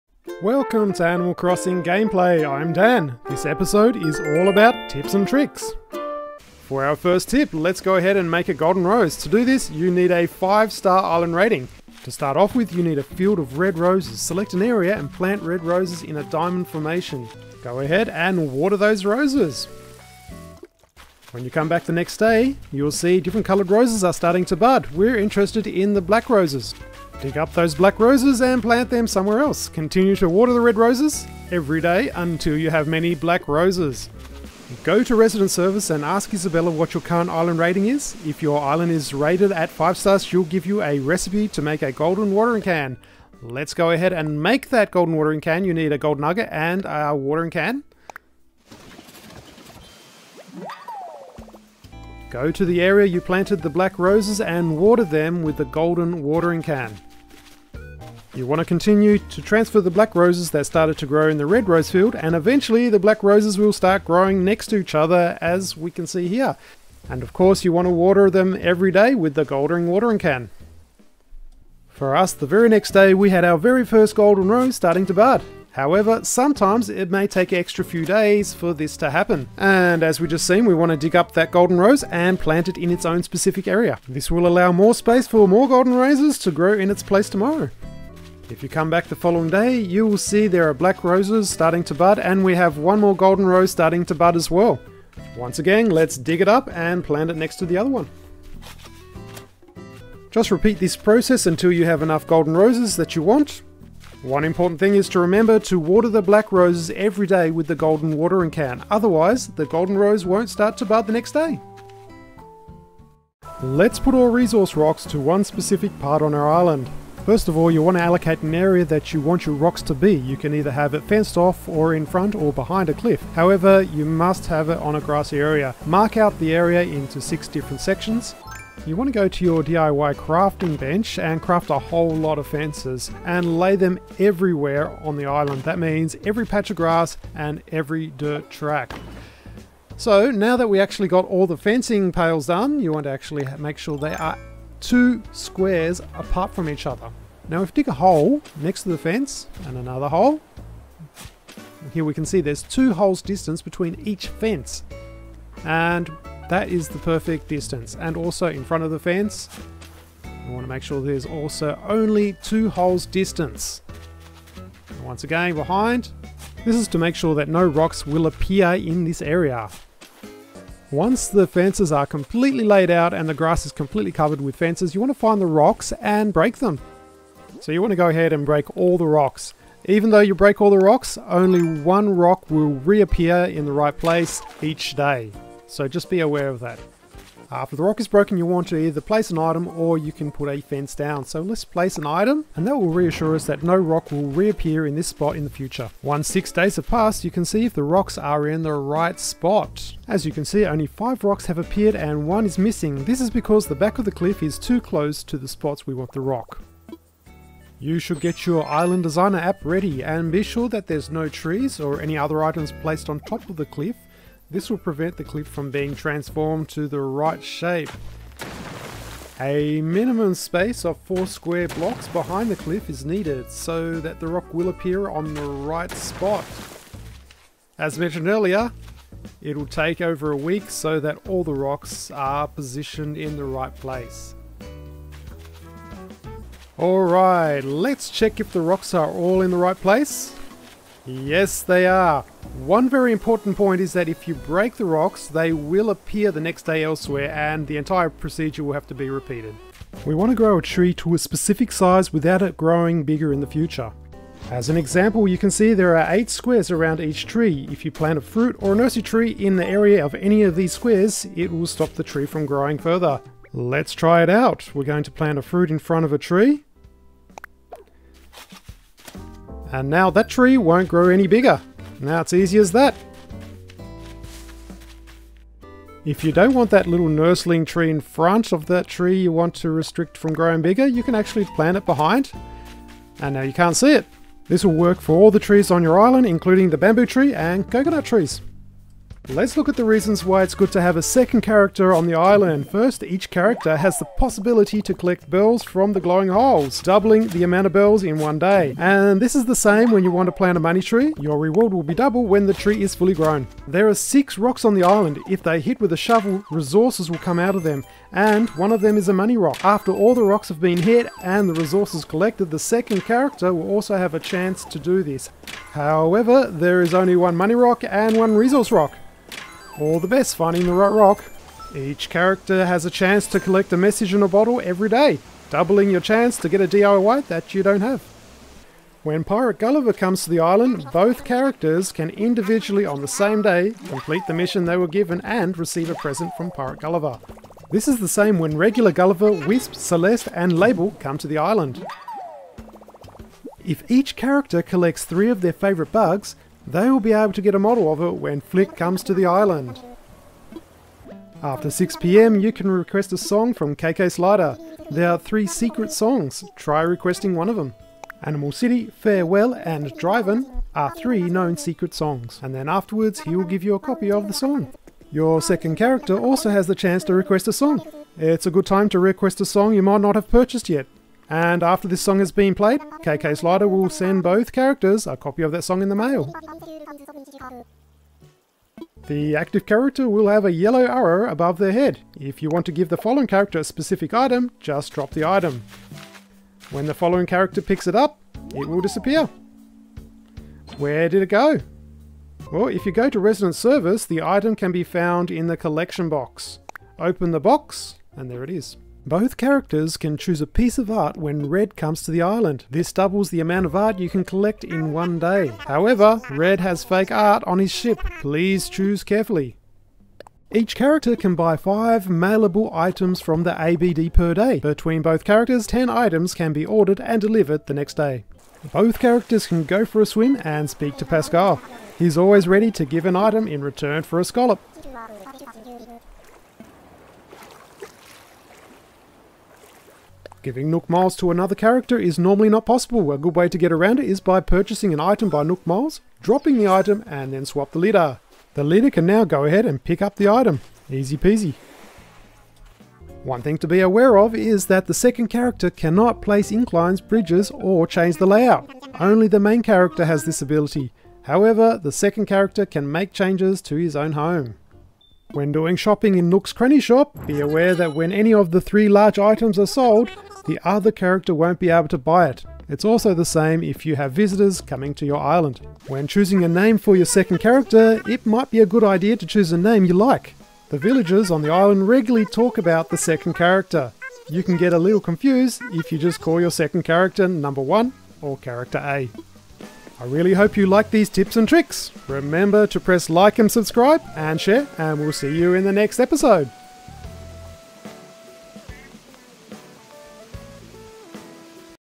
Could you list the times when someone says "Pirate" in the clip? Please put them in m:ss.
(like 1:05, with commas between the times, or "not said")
5:29, 5:36.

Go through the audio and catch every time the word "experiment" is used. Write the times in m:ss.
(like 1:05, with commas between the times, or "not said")
not said.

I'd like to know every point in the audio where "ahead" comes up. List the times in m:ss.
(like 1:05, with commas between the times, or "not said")
0:07, 0:17, 0:43, 2:58, 7:19.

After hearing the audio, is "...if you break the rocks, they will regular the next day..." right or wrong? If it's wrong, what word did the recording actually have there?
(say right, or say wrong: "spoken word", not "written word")
wrong: "appear", not "regular".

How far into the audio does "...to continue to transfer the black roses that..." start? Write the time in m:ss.
0:58.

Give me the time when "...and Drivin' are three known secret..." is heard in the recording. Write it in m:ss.
5:59.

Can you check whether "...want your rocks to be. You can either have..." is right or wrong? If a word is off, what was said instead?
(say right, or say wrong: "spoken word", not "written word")
right.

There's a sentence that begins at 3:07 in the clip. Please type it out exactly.
After the rock is broken, you want to either place an item or you can put a fence down.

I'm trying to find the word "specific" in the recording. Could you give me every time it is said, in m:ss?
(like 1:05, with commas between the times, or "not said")
1:23, 1:55, 4:11, 6:23.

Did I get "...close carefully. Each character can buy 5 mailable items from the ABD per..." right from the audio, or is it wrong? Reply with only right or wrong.
wrong.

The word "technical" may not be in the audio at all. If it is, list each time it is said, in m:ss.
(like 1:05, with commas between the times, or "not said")
not said.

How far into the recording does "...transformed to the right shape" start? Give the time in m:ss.
3:35.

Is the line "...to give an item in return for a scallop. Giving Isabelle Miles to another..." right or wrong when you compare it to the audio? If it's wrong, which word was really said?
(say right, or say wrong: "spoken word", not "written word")
wrong: "Nook", not "Isabelle".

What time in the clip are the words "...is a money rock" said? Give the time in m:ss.
5:08.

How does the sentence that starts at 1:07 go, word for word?
And of course you want to water them every day with the goldering watering can.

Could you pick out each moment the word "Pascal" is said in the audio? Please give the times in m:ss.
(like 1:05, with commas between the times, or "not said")
7:01.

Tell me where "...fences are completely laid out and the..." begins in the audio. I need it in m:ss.
2:51.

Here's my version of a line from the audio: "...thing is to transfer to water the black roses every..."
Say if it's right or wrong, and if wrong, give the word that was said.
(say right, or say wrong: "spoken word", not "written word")
wrong: "remember", not "transfer".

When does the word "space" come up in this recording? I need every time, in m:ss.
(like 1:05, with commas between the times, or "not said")
1:24, 3:40.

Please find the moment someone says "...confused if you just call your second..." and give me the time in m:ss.
7:55.